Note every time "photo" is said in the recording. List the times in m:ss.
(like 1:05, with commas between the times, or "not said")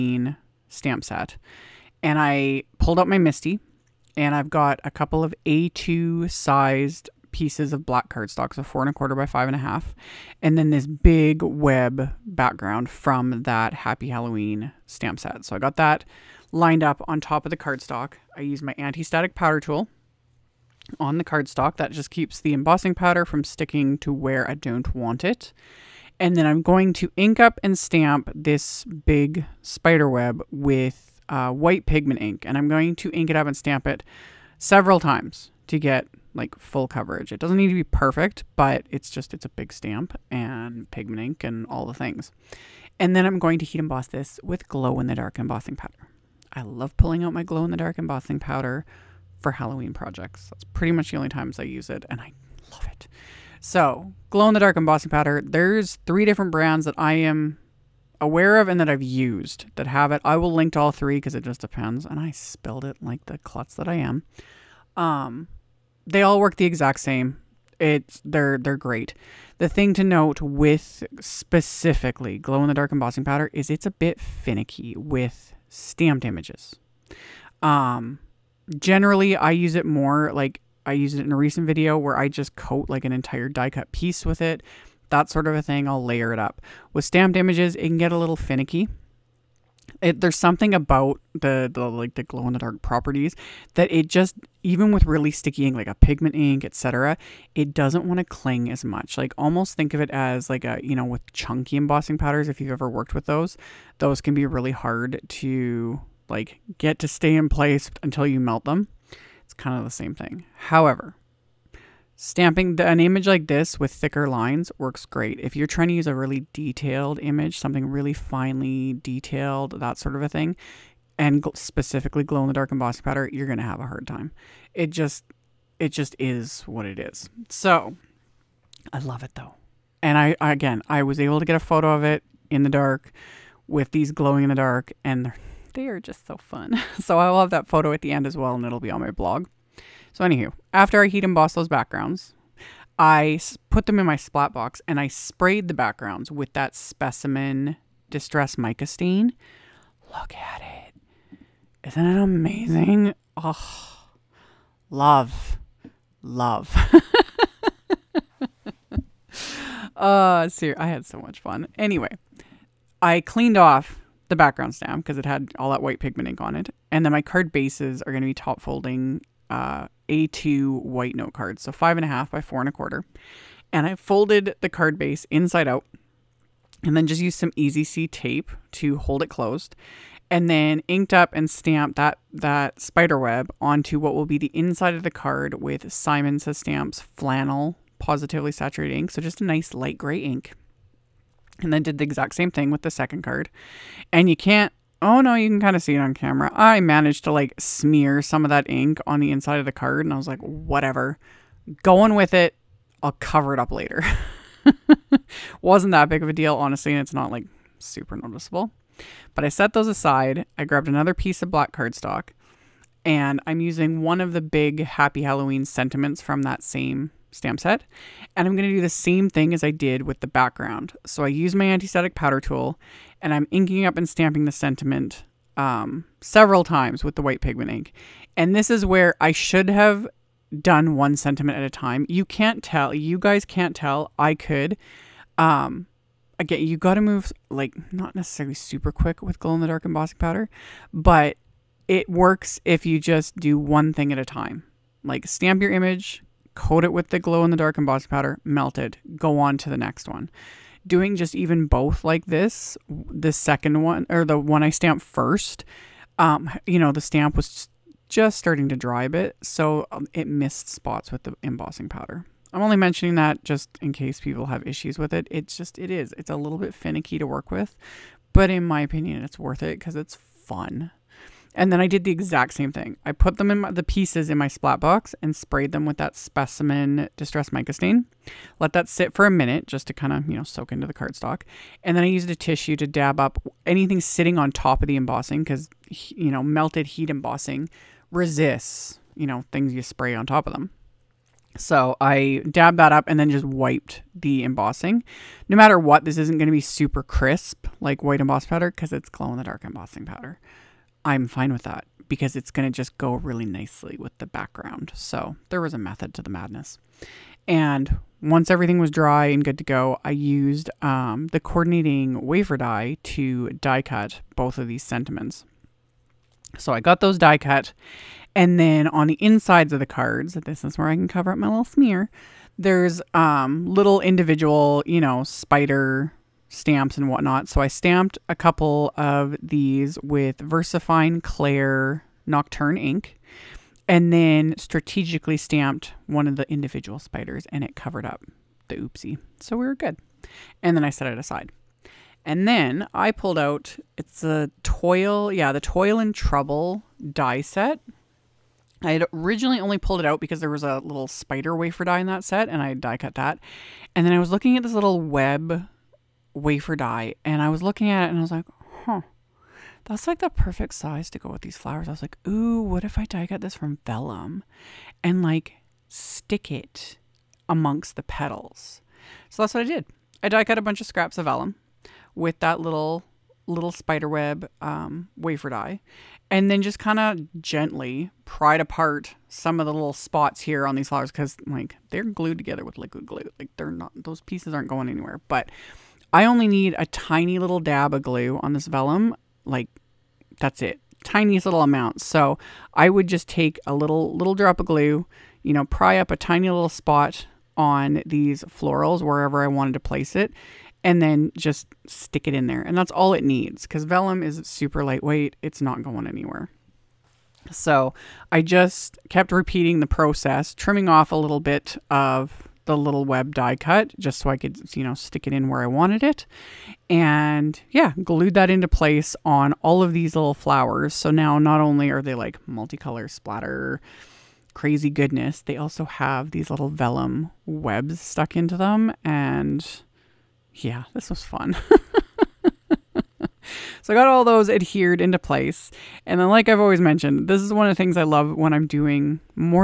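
2:11, 2:17.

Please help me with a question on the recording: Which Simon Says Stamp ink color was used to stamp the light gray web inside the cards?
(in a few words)
Flannel.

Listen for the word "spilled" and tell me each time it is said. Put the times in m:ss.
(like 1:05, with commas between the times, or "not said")
1:02.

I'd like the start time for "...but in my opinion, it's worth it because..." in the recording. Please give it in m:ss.
4:28.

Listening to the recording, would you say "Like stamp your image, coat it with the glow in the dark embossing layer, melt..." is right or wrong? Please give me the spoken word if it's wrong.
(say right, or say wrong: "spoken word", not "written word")
wrong: "powder", not "layer".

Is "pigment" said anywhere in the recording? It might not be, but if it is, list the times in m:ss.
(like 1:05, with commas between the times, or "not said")
0:31, 0:40, 1:35, 2:45, 3:47.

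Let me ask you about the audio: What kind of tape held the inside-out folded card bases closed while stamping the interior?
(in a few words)
Easy C tape.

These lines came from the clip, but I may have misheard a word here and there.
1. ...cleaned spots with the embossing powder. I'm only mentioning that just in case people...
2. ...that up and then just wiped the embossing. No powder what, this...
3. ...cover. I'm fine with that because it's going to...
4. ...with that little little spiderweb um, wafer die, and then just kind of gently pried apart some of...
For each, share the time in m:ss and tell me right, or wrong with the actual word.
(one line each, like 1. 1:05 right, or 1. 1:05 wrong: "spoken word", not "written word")
1. 4:20 wrong: "missed", not "cleaned"
2. 4:52 wrong: "matter", not "powder"
3. 5:00 wrong: "powder", not "cover"
4. 6:12 right.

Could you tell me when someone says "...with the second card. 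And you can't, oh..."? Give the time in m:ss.
3:12.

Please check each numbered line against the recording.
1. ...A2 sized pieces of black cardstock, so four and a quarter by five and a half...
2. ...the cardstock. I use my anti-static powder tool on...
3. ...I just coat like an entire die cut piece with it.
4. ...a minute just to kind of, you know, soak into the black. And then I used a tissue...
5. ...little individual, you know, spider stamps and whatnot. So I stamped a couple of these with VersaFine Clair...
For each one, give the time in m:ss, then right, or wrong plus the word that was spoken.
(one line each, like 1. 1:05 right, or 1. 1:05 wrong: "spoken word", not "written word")
1. 0:05 right
2. 0:17 right
3. 1:22 right
4. 4:39 wrong: "cardstock", not "black"
5. 5:23 right.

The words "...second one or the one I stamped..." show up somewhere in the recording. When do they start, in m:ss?
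4:13.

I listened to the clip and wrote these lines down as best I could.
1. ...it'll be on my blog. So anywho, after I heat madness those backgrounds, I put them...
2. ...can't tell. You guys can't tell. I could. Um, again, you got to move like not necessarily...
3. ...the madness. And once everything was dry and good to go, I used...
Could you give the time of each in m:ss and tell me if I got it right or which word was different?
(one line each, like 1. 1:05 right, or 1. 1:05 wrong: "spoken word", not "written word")
1. 2:18 wrong: "emboss", not "madness"
2. 3:52 right
3. 5:06 right.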